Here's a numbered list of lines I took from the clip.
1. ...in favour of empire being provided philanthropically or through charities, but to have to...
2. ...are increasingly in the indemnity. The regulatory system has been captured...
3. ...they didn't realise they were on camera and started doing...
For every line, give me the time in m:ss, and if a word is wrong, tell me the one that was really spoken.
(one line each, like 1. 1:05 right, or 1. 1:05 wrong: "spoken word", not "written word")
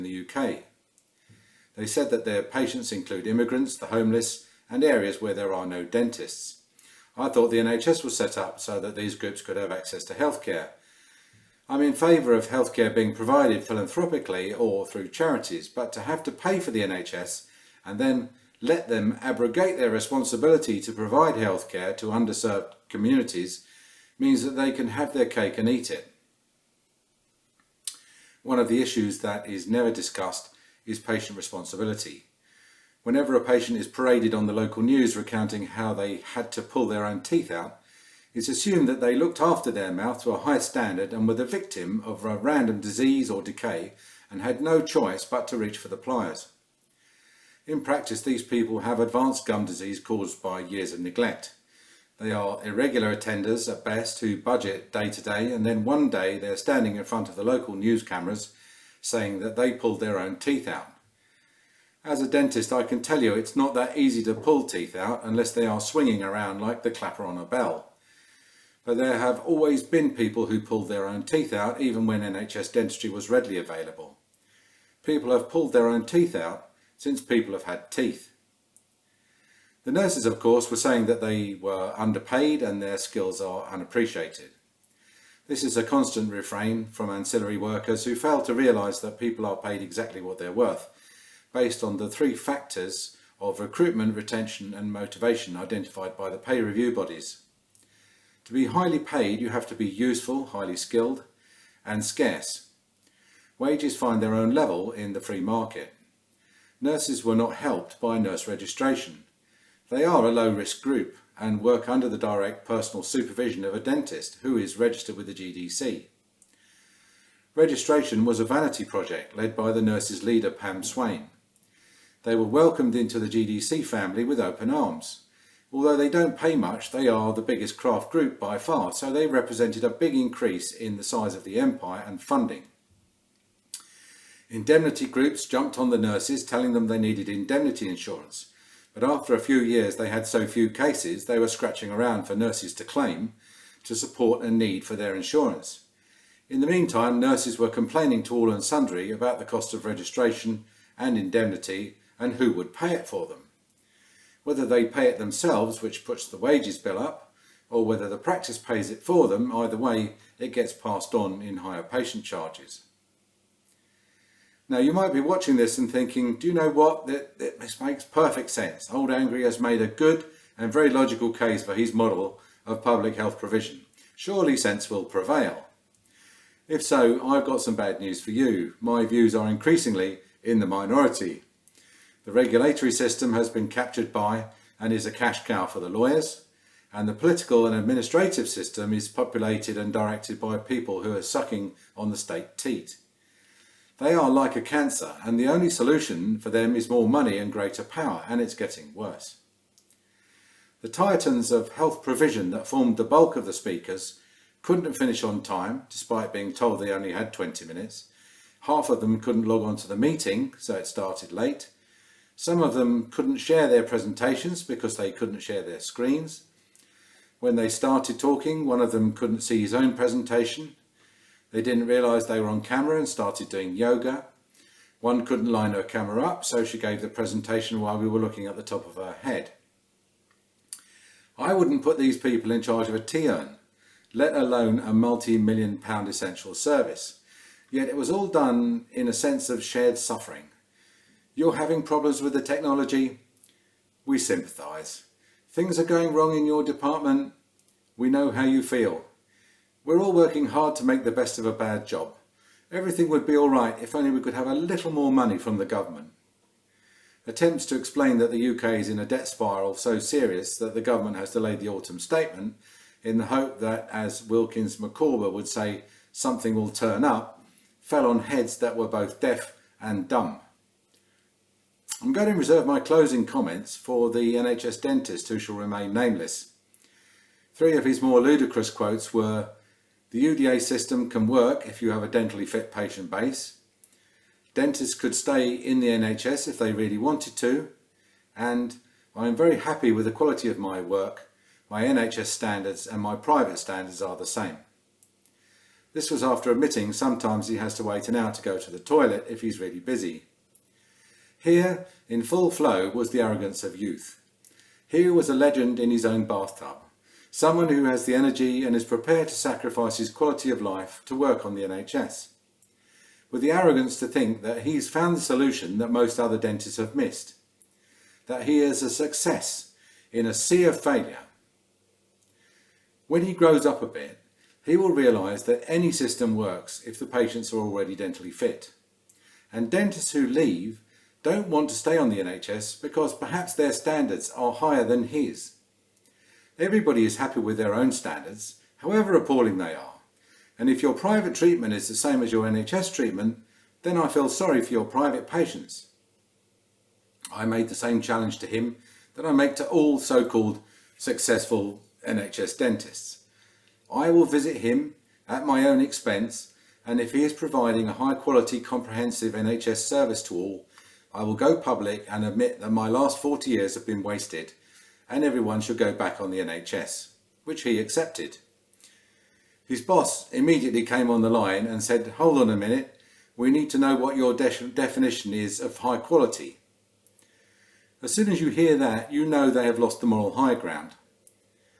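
1. 0:11 wrong: "healthcare", not "empire"
2. 2:59 wrong: "minority", not "indemnity"
3. 3:41 right.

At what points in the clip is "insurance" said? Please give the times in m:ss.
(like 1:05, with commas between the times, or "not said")
2:17, 2:25.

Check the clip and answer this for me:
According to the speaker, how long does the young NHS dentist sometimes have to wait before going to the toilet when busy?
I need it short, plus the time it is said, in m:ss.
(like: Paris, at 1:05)
an hour, at 4:58.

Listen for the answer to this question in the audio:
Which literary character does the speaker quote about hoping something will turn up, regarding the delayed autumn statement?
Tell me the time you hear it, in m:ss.
4:24.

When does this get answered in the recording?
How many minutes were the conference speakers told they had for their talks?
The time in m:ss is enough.
3:27.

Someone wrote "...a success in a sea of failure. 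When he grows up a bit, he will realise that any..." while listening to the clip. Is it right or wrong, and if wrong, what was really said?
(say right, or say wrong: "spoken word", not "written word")
right.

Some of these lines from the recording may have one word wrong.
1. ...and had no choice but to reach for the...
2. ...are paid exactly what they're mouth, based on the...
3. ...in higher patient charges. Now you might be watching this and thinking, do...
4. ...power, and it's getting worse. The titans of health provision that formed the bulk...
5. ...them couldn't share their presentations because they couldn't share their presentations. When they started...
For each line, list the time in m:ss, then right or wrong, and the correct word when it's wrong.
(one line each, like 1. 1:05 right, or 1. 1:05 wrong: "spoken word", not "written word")
1. 0:44 right
2. 1:29 wrong: "worth", not "mouth"
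3. 2:41 right
4. 3:17 right
5. 3:32 wrong: "screens", not "presentations".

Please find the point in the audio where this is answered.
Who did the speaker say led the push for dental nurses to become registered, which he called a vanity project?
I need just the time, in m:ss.
2:00.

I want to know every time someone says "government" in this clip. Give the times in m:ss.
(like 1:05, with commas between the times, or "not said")
4:15, 4:20.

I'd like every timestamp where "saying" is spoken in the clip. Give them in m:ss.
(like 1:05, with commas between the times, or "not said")
0:59, 1:20.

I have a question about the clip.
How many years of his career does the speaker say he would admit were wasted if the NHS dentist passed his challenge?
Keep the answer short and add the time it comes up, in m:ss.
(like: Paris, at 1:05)
40, at 6:03.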